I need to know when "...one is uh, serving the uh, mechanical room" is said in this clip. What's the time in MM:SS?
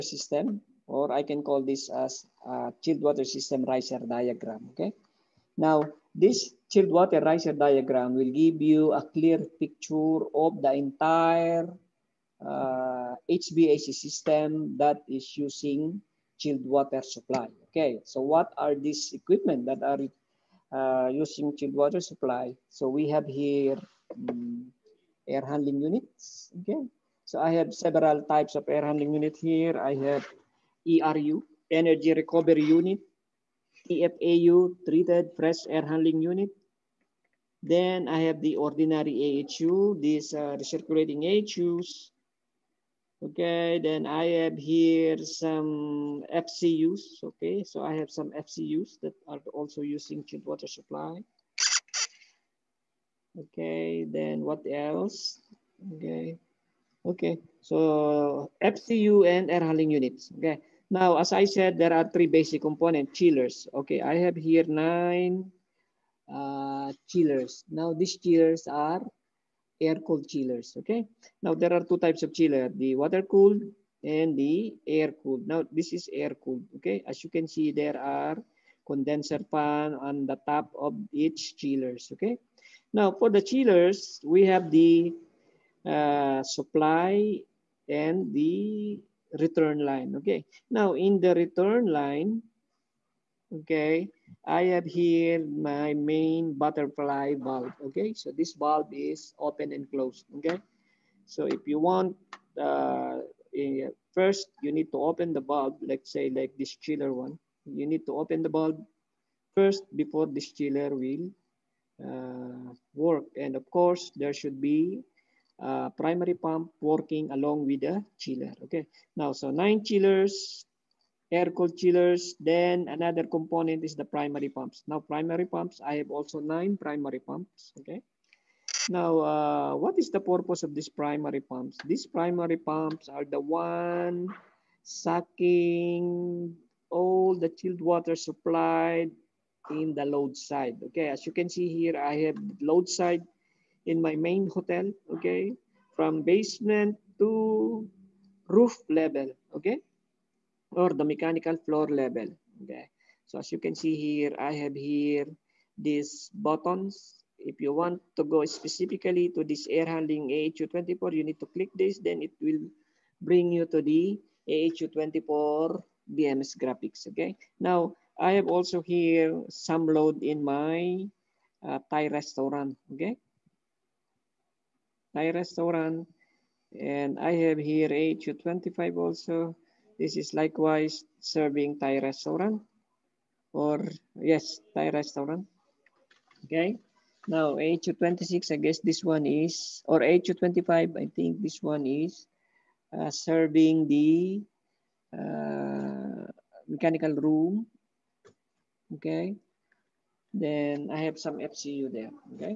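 03:11.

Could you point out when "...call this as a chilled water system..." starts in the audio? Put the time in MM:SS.
00:01.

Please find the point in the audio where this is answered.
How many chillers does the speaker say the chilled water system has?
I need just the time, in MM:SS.
01:04.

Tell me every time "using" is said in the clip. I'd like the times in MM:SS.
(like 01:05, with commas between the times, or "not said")
00:15, 00:21, 00:49.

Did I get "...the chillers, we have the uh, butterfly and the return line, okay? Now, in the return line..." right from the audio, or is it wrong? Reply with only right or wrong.
wrong.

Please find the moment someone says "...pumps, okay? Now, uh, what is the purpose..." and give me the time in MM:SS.
02:07.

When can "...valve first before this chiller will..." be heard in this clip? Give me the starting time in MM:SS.
01:48.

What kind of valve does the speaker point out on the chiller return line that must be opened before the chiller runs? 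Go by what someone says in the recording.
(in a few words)
butterfly valve.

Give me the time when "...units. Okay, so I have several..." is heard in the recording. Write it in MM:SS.
00:25.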